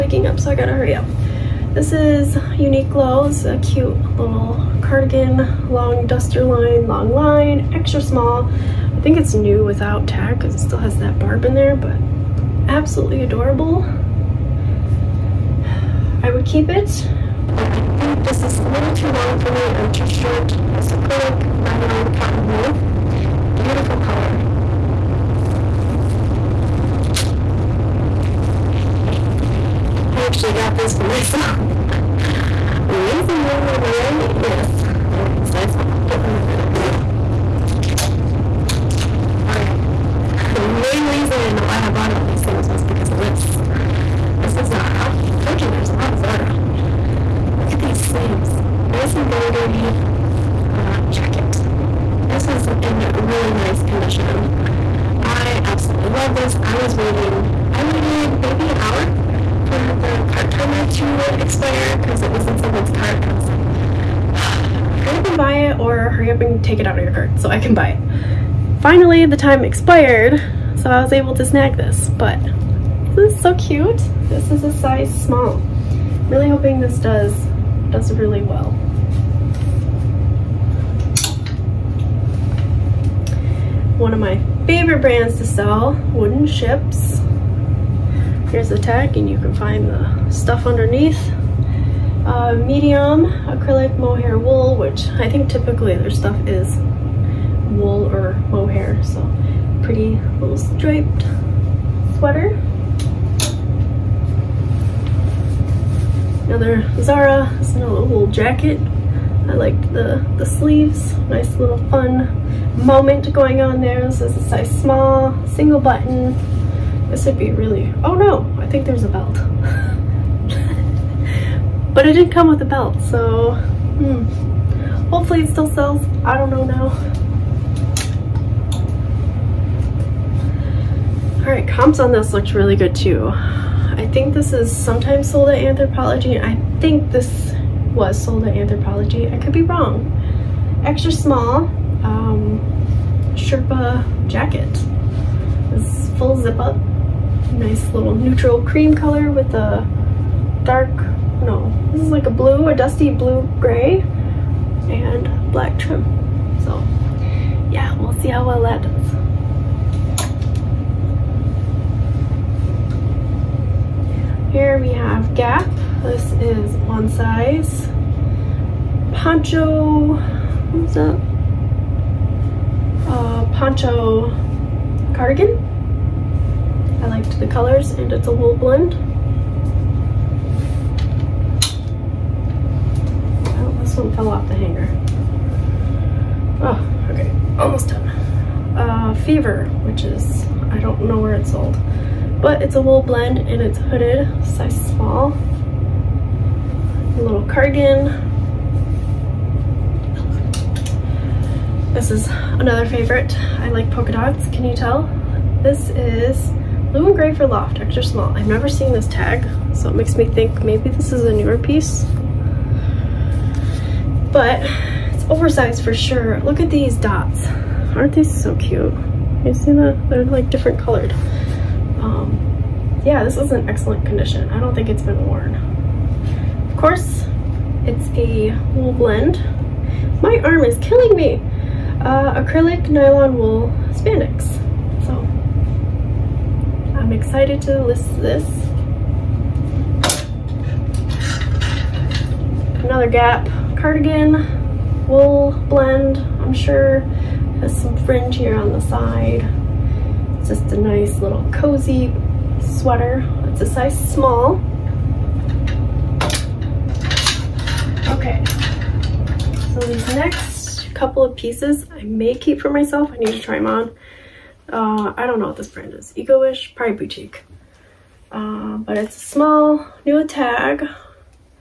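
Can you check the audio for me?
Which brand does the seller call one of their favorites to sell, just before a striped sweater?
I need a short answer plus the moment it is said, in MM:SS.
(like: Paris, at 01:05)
Wooden Ships, at 01:26.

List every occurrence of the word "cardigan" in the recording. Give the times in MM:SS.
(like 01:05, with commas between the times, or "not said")
00:04, 02:55, 03:17, 04:03.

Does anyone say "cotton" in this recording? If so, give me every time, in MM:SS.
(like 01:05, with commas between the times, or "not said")
00:22.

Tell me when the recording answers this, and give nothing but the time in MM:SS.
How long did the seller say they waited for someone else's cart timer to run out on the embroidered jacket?
00:58.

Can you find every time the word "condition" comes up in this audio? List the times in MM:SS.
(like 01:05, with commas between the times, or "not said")
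00:53, 03:44.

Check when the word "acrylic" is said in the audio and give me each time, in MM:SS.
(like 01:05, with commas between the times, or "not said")
00:20, 01:33, 03:52.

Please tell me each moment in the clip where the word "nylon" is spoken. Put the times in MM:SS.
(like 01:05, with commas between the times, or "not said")
00:21, 03:52.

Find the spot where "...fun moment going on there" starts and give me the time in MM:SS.
01:51.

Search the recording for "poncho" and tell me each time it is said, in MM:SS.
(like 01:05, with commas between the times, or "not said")
02:49, 02:53.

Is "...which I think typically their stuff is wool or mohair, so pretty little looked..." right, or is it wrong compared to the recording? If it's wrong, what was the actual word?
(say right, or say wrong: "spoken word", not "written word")
wrong: "striped", not "looked".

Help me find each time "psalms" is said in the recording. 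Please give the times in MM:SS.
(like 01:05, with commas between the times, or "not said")
not said.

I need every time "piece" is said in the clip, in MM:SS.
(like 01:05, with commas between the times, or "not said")
03:31, 04:21.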